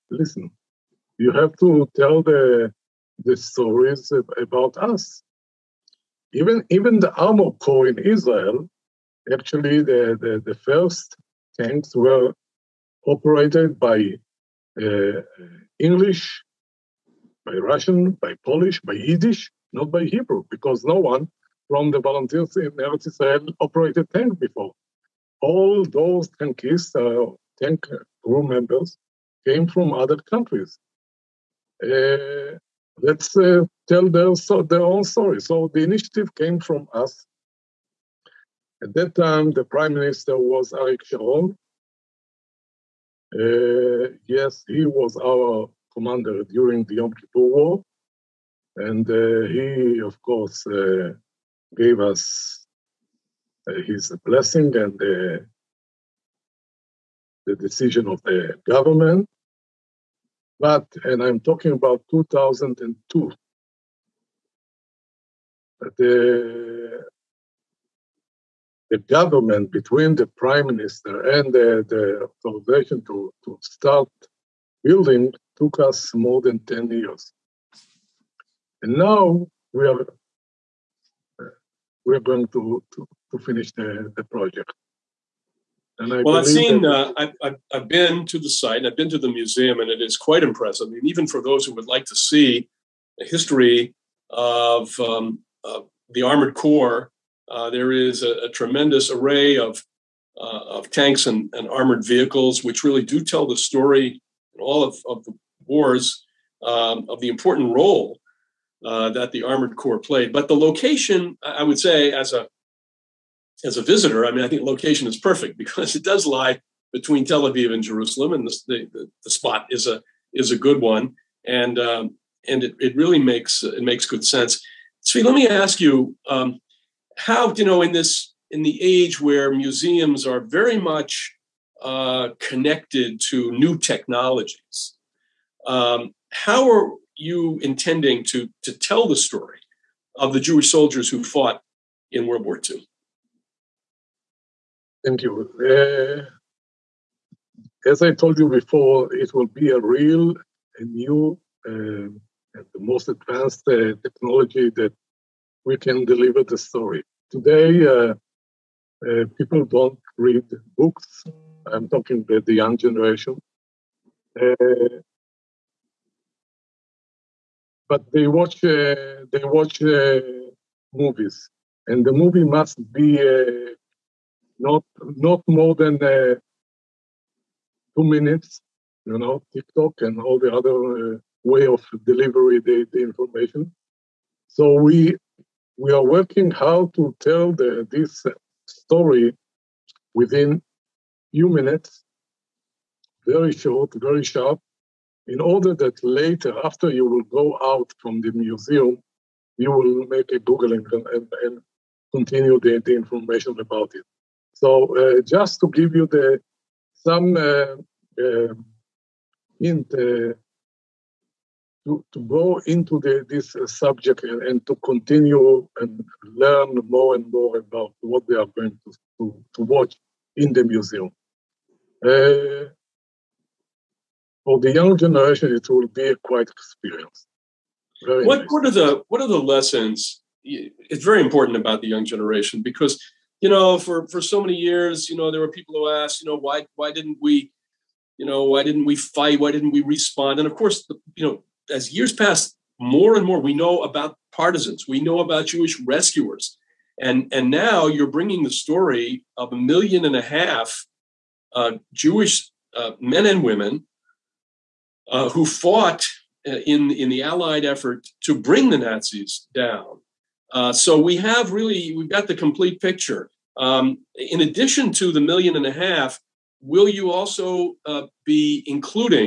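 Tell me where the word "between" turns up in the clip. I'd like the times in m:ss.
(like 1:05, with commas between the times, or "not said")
1:09, 1:56.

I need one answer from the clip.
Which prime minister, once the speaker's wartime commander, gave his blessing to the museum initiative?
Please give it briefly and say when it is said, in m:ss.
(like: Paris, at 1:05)
Arik Sharon, at 0:40.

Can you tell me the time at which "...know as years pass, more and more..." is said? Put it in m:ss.
4:01.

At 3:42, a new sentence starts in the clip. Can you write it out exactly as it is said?
Uh, for the young generation, it will be a quite experience.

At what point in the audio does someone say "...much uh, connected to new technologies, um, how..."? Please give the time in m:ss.
2:10.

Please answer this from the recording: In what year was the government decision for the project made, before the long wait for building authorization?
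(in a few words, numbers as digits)
2002.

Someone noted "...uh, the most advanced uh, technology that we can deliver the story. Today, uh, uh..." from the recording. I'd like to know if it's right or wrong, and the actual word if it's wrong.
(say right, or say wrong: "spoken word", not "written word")
right.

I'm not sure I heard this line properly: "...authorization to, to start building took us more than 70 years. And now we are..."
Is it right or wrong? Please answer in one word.
wrong.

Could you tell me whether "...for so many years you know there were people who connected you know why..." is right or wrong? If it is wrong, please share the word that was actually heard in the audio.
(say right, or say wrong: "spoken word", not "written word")
wrong: "asked", not "connected".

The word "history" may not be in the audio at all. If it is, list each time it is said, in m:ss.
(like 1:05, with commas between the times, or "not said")
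1:33.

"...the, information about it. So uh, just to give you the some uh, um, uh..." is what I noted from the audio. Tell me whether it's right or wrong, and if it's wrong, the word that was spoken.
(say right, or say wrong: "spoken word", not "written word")
right.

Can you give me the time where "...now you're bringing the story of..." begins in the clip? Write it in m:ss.
4:07.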